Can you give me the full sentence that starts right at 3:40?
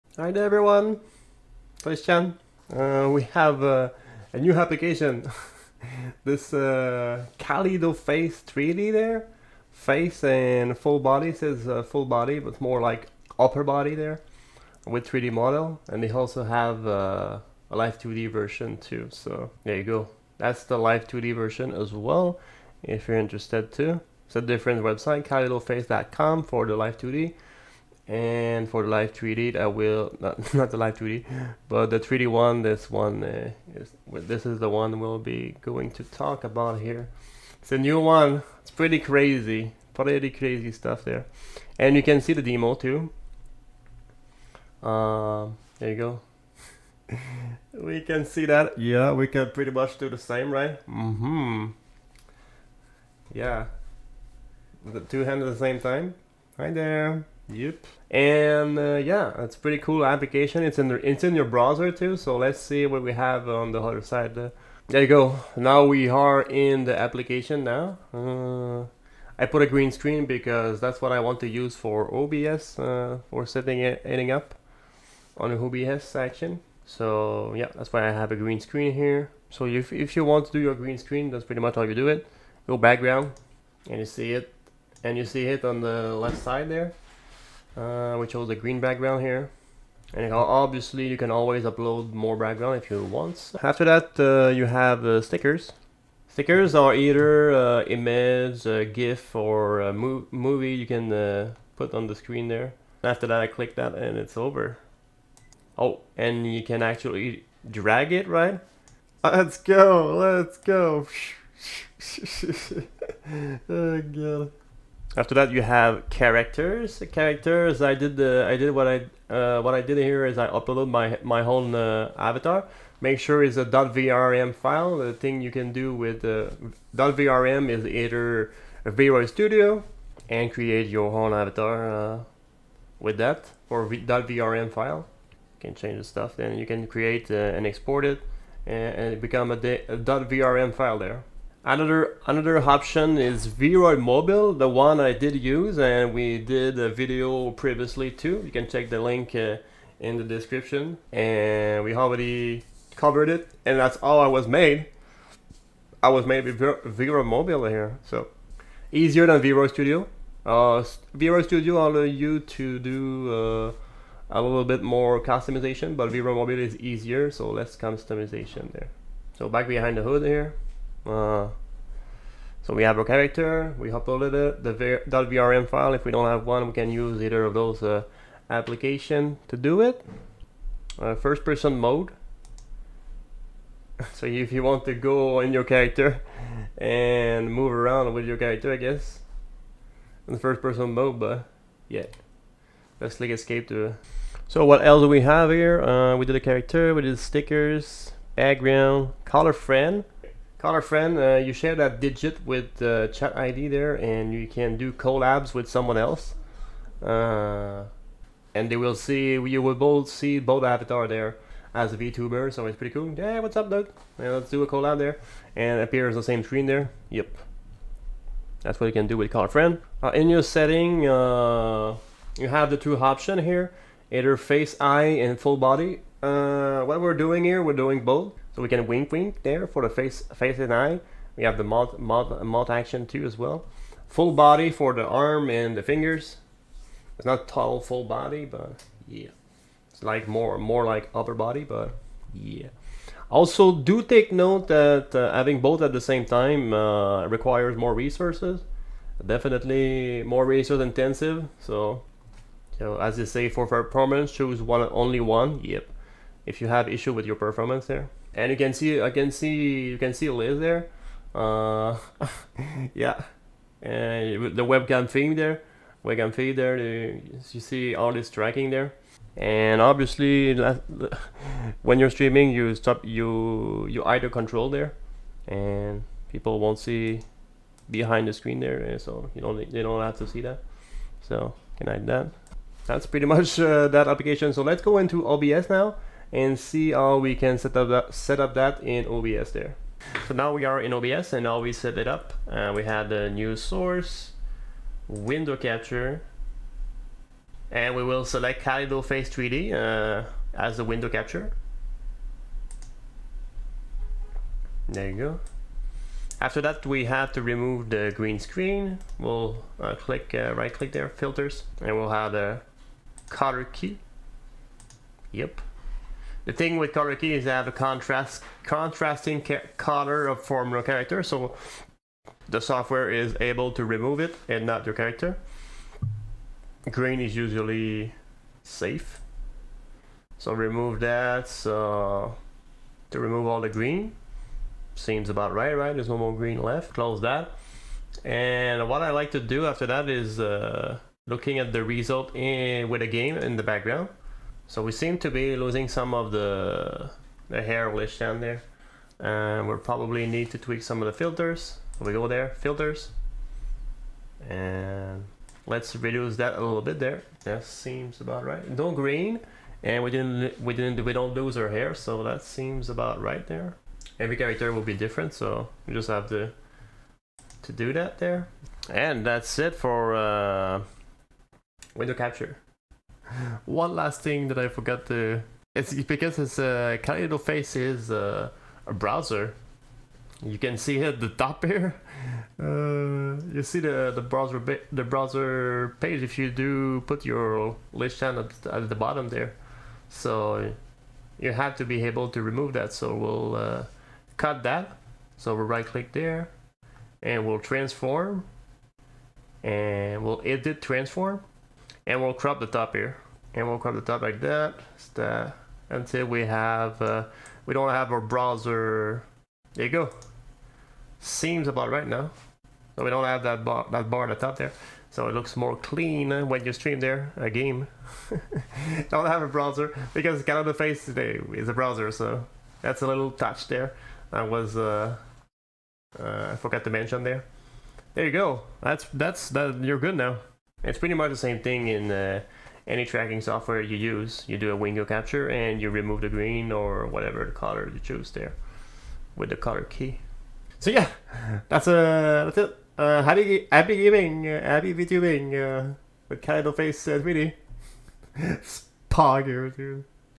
Uh, in your setting, uh, you have the two option here, either face, eye, and full body.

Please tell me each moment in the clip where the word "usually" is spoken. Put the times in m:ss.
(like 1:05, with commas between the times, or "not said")
5:27.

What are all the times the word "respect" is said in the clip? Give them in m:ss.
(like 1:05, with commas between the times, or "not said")
not said.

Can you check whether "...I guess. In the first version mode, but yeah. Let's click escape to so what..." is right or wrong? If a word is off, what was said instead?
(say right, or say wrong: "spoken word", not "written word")
wrong: "person", not "version".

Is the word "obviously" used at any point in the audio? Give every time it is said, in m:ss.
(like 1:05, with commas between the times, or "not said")
1:30, 4:29.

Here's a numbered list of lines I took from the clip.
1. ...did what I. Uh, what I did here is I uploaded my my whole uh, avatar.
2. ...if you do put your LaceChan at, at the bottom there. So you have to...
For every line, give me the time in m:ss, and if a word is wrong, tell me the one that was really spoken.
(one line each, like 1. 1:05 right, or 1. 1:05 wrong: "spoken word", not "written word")
1. 1:58 right
2. 6:26 right.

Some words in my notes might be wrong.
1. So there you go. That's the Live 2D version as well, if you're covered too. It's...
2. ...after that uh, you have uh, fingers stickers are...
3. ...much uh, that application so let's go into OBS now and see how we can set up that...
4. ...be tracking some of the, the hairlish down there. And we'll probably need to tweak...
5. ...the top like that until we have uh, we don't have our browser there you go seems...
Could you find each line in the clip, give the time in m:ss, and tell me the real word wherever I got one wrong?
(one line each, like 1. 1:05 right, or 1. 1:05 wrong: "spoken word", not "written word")
1. 0:19 wrong: "interested", not "covered"
2. 1:33 wrong: "stickers", not "fingers"
3. 4:43 right
4. 5:45 wrong: "losing", not "tracking"
5. 6:43 right.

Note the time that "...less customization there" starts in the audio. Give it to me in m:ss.
2:47.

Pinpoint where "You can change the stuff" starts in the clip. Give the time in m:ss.
2:15.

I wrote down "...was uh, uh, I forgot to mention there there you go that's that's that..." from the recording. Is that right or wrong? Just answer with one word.
right.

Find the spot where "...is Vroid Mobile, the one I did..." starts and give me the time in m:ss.
2:23.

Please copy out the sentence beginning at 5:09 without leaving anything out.
We'll uh, click, uh, right click there, filters, and we'll have the color key.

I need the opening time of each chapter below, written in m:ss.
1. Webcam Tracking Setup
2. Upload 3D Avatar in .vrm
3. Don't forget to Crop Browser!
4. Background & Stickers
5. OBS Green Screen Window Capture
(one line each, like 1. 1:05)
1. 3:39
2. 1:54
3. 6:13
4. 1:04
5. 4:49.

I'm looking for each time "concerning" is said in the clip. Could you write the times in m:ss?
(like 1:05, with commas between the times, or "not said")
not said.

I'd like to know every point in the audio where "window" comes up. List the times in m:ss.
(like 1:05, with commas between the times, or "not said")
4:55, 5:00, 6:11, 7:14.